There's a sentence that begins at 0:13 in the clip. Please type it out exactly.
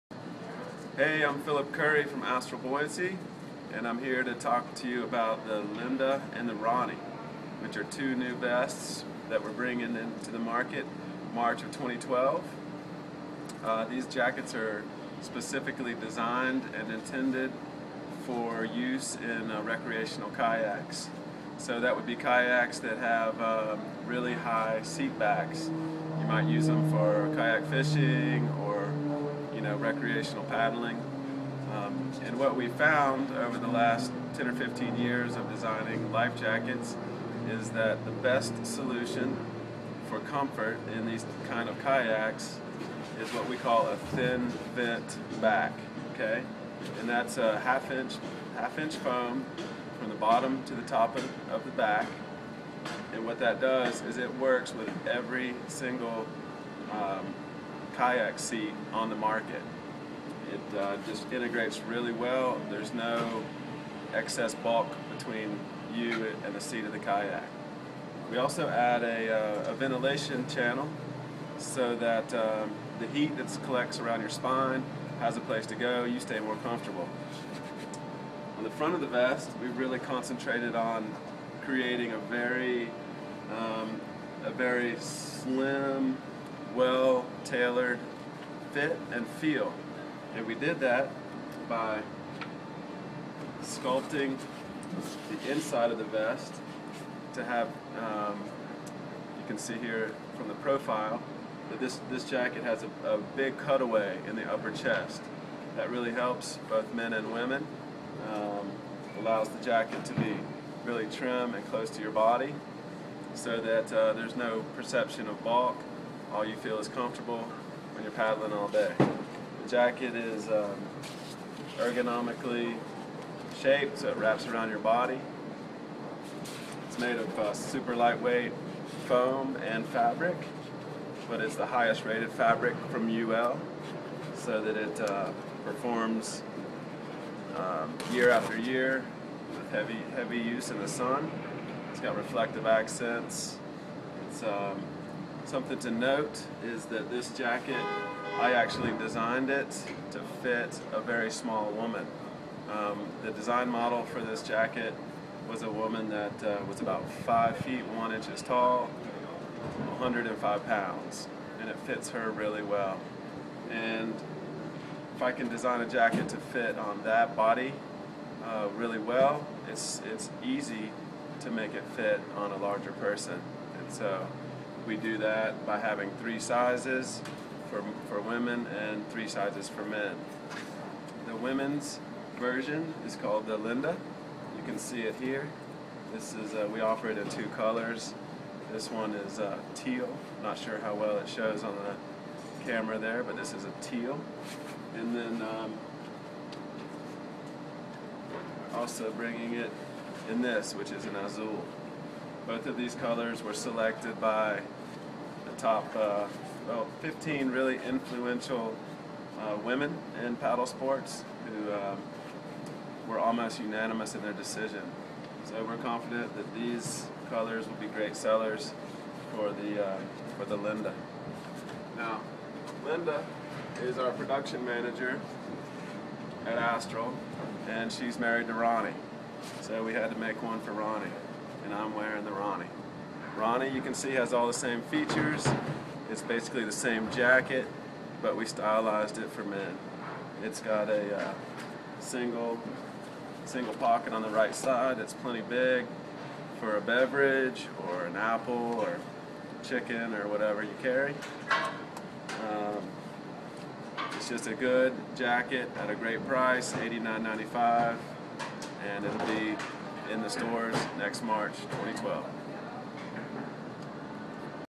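Uh, these jackets are specifically designed and intended for use in uh, recreational kayaks.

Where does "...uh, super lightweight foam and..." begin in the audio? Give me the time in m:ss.
2:07.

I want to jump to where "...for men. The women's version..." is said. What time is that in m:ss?
2:59.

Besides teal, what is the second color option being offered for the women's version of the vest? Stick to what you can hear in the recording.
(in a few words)
azul.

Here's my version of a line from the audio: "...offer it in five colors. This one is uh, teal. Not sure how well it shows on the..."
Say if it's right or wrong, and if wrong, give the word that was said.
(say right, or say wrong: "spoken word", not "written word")
wrong: "two", not "five".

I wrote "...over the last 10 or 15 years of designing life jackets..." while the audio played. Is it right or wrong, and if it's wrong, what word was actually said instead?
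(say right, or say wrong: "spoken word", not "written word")
right.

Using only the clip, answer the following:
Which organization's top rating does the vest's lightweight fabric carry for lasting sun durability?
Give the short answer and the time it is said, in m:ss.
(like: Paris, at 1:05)
UL, at 2:13.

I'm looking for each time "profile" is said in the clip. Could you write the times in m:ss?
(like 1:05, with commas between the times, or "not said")
1:40.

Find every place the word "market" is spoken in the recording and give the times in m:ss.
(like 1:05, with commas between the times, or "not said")
0:10, 0:59.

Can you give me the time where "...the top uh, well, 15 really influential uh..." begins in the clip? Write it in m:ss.
3:25.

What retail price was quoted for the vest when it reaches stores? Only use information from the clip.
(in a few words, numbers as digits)
$89.95.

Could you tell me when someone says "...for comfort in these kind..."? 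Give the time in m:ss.
0:40.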